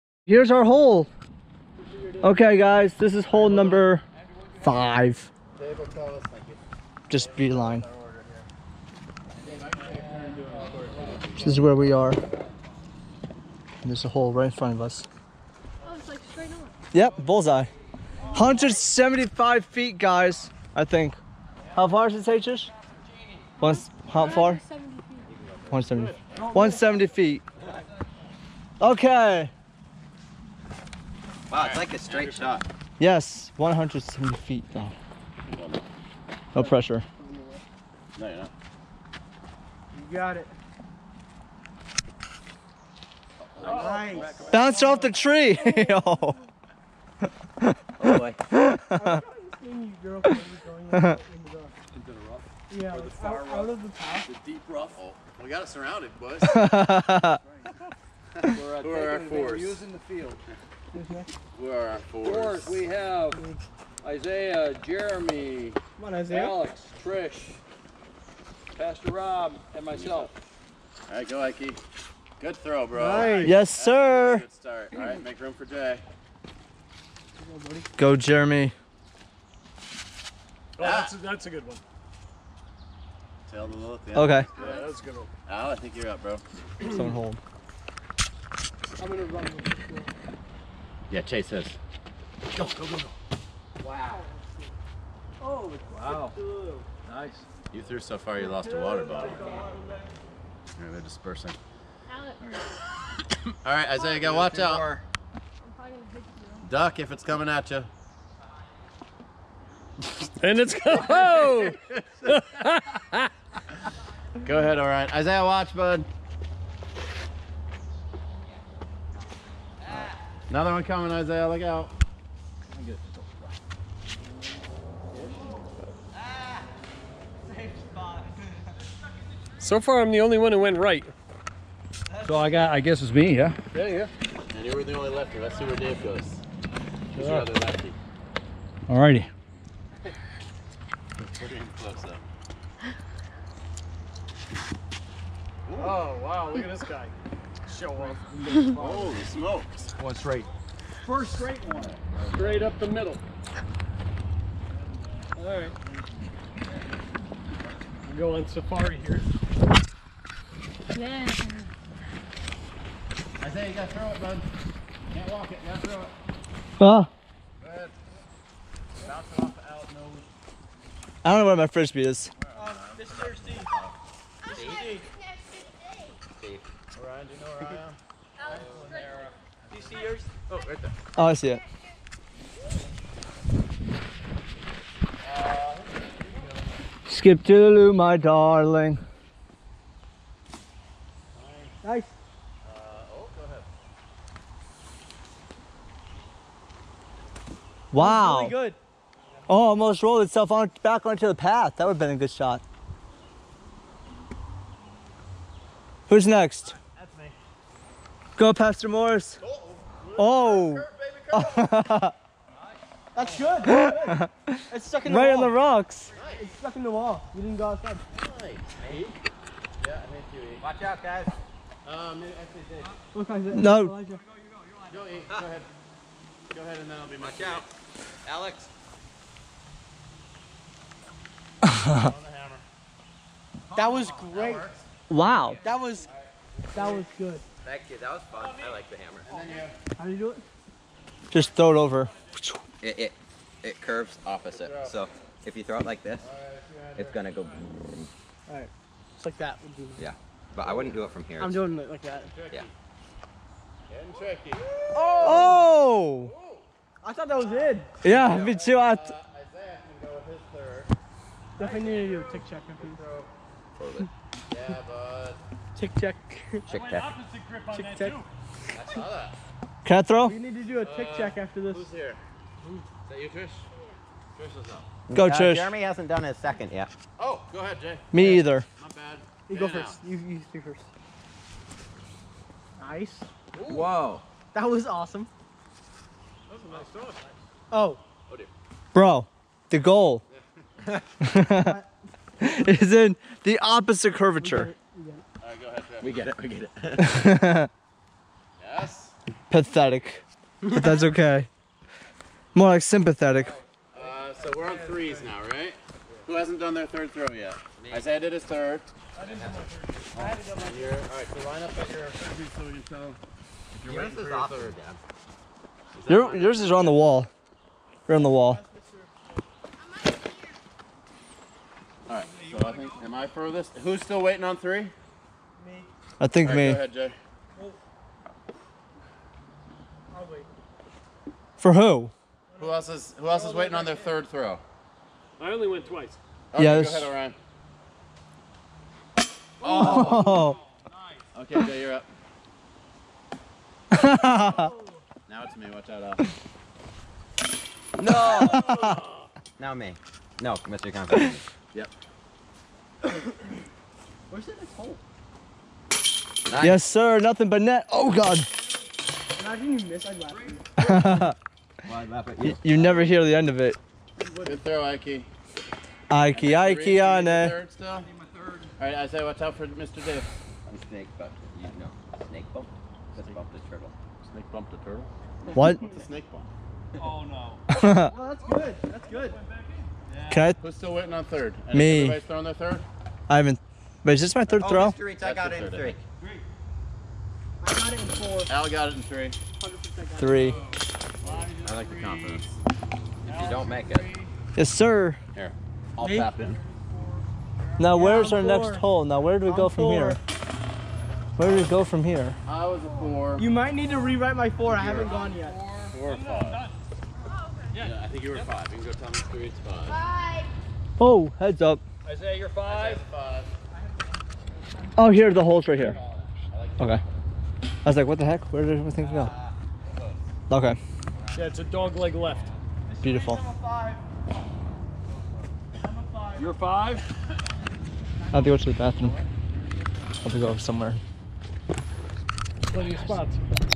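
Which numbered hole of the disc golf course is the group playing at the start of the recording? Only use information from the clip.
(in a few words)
5.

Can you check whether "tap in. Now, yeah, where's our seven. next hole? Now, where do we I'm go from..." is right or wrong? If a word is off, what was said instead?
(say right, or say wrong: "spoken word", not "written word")
wrong: "four", not "seven".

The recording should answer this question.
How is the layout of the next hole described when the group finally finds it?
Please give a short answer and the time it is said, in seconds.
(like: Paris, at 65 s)
Dog leg left, at 421 s.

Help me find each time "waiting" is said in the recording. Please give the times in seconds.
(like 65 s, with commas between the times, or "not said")
324 s, 333 s, 380 s.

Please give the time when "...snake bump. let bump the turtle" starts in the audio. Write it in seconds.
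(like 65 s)
372 s.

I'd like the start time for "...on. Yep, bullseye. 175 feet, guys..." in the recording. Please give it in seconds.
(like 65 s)
16 s.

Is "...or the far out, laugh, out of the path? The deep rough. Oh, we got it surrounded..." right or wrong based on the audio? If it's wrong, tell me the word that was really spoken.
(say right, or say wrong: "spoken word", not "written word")
wrong: "rough", not "laugh".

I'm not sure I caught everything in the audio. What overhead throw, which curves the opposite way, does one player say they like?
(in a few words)
The hammer.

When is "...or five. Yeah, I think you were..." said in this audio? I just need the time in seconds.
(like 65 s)
406 s.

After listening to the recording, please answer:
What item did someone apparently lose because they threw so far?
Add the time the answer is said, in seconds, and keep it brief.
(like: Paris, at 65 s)
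Water bottle, at 97 s.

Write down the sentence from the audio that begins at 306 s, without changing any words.
Who hasn't done their third throw yet?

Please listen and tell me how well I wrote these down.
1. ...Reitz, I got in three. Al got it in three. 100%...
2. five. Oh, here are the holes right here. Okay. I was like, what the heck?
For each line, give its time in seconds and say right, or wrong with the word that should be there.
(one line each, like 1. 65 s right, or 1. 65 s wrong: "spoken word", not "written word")
1. 385 s right
2. 413 s right.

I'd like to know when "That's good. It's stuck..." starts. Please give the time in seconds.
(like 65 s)
213 s.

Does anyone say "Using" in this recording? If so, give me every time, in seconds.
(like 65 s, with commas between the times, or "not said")
59 s.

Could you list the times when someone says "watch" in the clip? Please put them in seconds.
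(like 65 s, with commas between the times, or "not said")
104 s, 115 s, 220 s, 345 s, 369 s.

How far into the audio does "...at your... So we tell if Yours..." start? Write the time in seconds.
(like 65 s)
311 s.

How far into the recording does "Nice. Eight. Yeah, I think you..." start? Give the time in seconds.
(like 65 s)
218 s.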